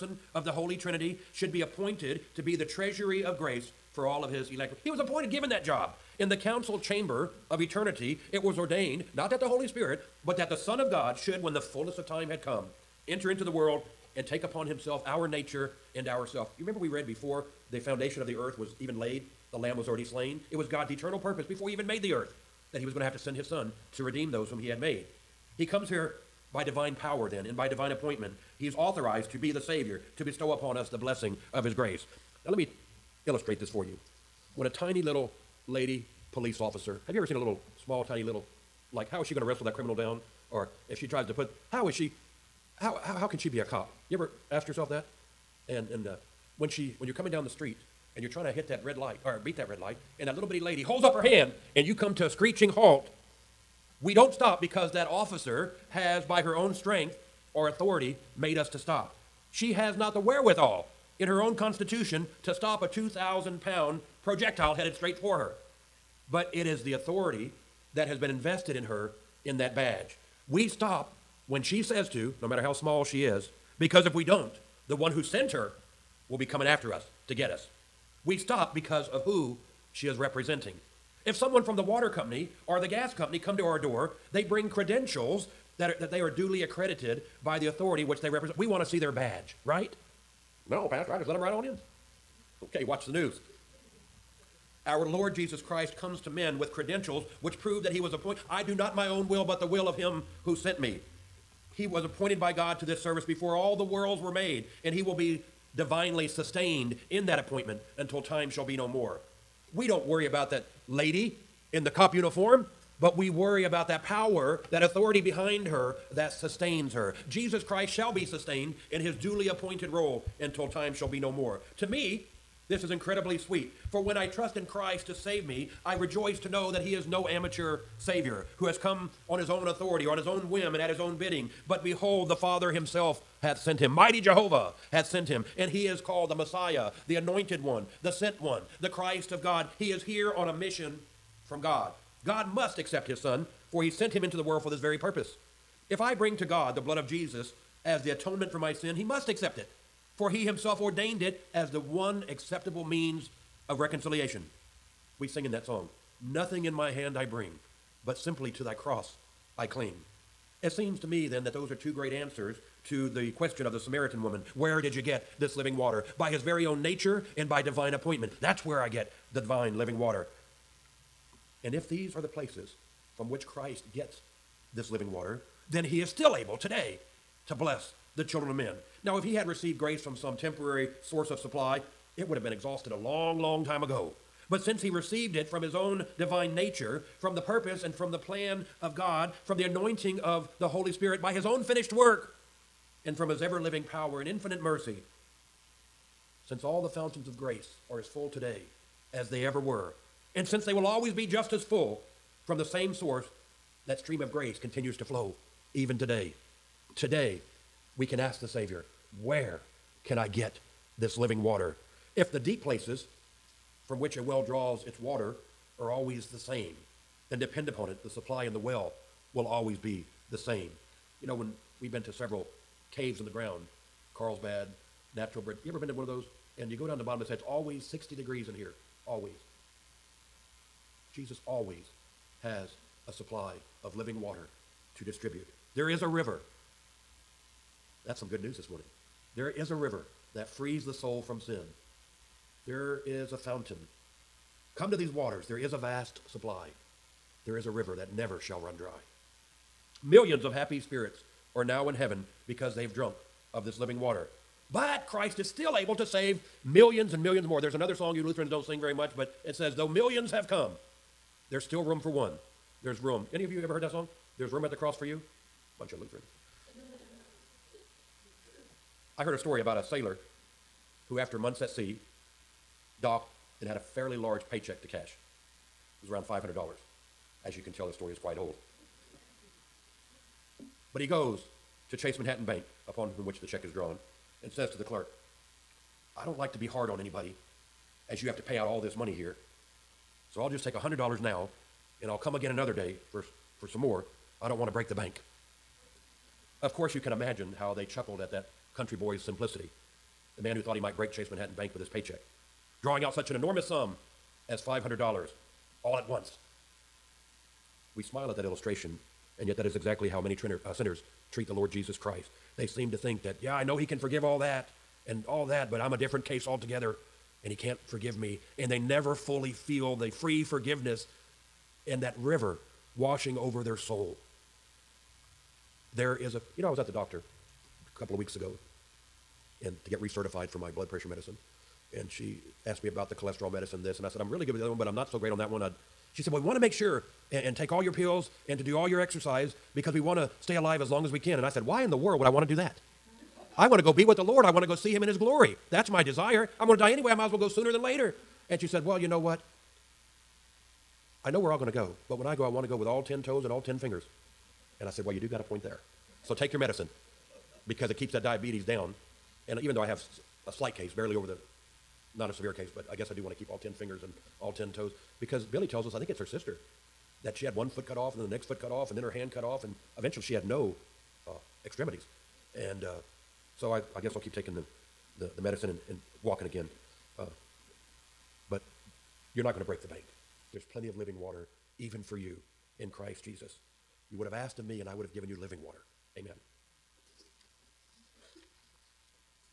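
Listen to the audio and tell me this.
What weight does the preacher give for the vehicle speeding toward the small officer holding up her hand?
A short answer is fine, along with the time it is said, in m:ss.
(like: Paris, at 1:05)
2,000 pound, at 1:02.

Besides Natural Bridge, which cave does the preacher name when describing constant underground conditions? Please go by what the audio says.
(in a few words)
Carlsbad.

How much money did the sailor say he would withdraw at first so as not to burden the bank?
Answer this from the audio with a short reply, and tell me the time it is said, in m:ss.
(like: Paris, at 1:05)
$100, at 4:50.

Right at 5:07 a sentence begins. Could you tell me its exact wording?
We smile at that illustration, and yet that is exactly how many trinner, uh, sinners treat the Lord Jesus Christ.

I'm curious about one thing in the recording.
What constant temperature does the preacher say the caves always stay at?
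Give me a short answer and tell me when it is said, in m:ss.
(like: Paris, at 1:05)
60 degrees, at 3:47.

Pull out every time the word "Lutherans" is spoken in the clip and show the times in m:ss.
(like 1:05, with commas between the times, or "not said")
4:18, 4:25.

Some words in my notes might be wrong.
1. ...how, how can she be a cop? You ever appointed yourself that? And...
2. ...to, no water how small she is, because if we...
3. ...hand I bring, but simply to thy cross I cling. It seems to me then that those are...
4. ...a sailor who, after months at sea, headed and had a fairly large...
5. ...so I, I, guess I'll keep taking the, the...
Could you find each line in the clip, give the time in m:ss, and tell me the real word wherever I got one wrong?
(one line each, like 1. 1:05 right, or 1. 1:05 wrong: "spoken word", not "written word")
1. 0:43 wrong: "asked", not "appointed"
2. 1:12 wrong: "matter", not "water"
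3. 2:36 right
4. 4:29 wrong: "docked", not "headed"
5. 6:13 right.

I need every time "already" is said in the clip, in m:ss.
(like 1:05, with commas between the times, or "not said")
0:19.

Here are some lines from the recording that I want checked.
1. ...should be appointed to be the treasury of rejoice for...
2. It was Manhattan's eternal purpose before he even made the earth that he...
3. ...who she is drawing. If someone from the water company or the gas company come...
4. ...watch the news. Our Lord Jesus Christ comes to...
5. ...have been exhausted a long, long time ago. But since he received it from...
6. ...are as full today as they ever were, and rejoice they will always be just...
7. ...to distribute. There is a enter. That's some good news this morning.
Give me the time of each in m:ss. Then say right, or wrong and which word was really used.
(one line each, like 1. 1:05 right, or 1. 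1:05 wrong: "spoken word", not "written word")
1. 0:01 wrong: "grace", not "rejoice"
2. 0:20 wrong: "God", not "Manhattan"
3. 1:19 wrong: "representing", not "drawing"
4. 1:32 right
5. 3:02 right
6. 3:17 wrong: "since", not "rejoice"
7. 3:54 wrong: "river", not "enter".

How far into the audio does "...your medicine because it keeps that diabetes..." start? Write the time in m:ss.
5:56.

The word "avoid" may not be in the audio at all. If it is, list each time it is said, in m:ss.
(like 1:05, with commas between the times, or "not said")
not said.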